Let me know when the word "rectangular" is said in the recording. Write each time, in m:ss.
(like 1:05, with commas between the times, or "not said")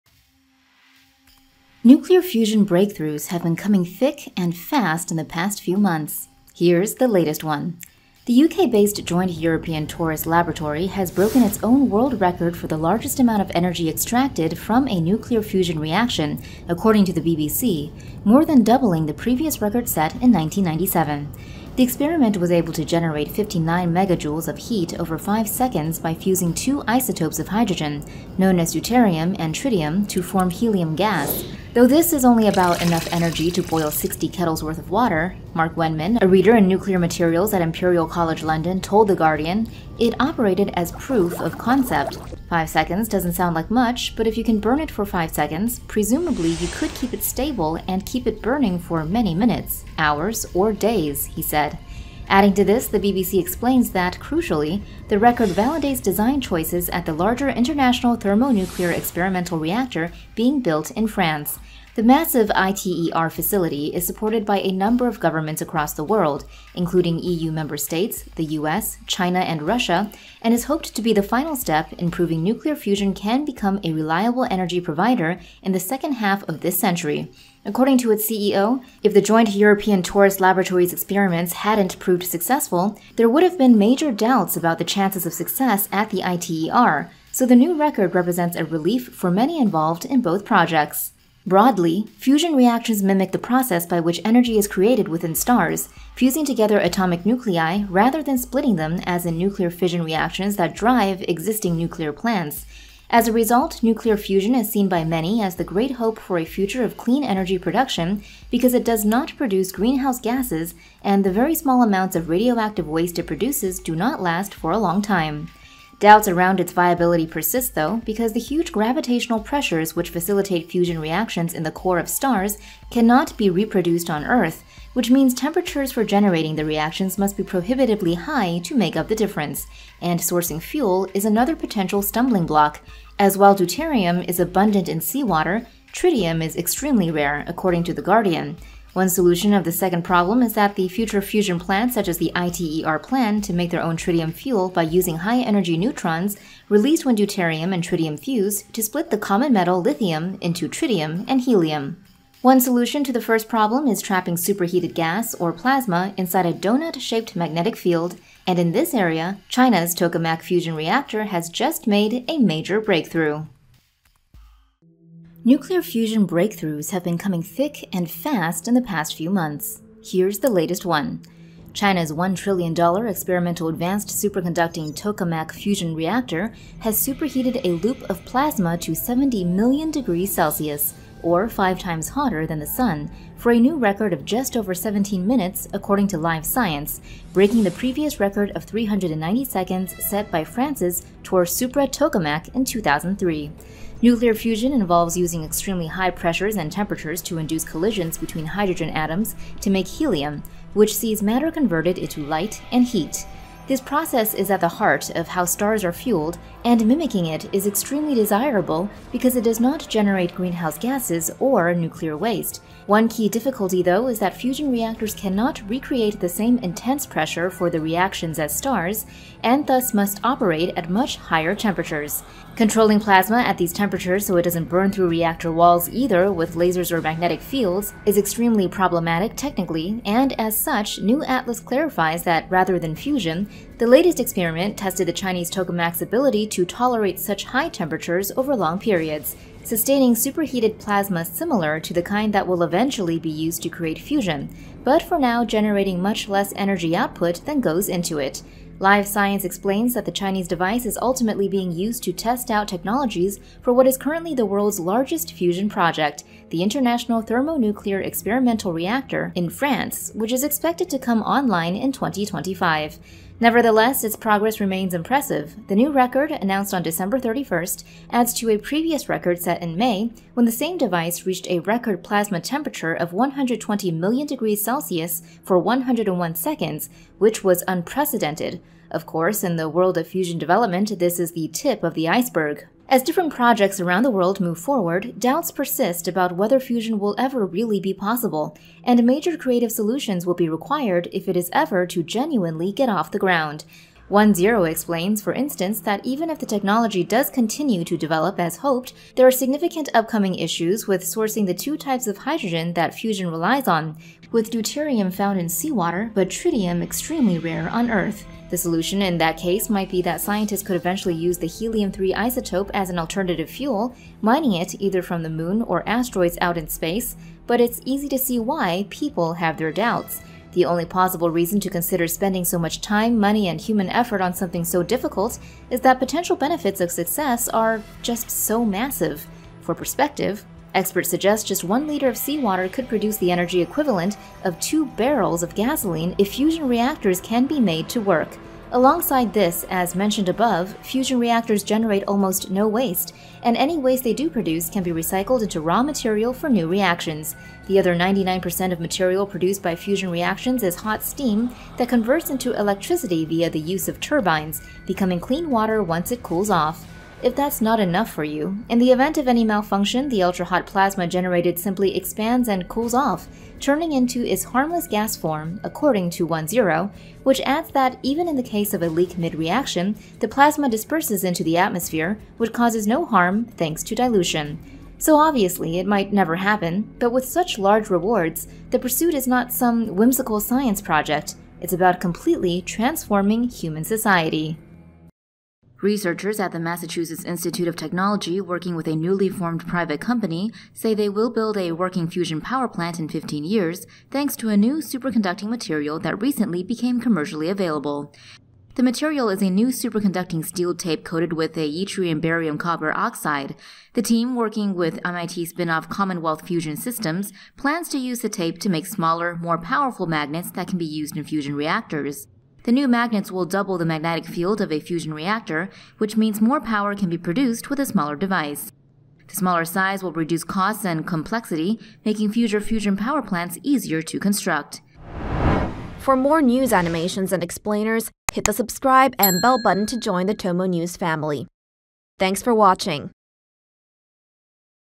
not said.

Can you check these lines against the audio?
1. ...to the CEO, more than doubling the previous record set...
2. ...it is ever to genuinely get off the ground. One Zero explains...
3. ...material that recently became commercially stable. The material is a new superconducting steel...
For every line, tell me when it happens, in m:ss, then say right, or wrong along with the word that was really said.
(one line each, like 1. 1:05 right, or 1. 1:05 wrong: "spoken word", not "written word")
1. 0:17 wrong: "BBC", not "CEO"
2. 4:51 right
3. 6:35 wrong: "available", not "stable".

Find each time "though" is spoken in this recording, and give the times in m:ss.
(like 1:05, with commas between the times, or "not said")
0:31, 1:57, 3:33.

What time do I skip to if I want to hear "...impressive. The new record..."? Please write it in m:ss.
4:24.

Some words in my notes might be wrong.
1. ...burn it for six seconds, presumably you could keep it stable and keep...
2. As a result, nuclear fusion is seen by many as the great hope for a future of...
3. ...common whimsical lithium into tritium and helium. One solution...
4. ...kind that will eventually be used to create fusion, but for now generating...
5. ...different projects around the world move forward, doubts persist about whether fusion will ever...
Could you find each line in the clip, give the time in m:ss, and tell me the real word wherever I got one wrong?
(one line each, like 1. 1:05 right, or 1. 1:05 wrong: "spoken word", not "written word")
1. 0:44 wrong: "five", not "six"
2. 1:43 right
3. 2:29 wrong: "metal", not "whimsical"
4. 4:02 right
5. 4:43 right.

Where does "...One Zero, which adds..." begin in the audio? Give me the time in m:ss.
6:06.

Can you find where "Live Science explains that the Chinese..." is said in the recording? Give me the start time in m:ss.
4:08.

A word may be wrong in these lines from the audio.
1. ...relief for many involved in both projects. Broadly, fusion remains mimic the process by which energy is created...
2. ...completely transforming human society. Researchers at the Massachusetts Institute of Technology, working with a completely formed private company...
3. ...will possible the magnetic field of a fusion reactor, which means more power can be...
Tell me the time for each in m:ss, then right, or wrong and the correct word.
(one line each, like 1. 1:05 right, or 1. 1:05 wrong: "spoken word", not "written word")
1. 1:28 wrong: "reactions", not "remains"
2. 6:22 wrong: "newly", not "completely"
3. 6:53 wrong: "double", not "possible".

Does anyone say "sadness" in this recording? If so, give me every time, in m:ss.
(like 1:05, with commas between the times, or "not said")
not said.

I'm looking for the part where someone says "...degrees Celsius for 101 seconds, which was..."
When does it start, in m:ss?
4:34.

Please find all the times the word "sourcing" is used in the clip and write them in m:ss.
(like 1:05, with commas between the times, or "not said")
2:10, 5:01.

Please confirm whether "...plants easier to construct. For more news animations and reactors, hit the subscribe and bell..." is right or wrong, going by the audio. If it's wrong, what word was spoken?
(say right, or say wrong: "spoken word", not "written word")
wrong: "explainers", not "reactors".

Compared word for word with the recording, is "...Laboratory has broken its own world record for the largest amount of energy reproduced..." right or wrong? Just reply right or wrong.
wrong.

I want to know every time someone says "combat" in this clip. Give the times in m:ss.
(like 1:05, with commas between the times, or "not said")
not said.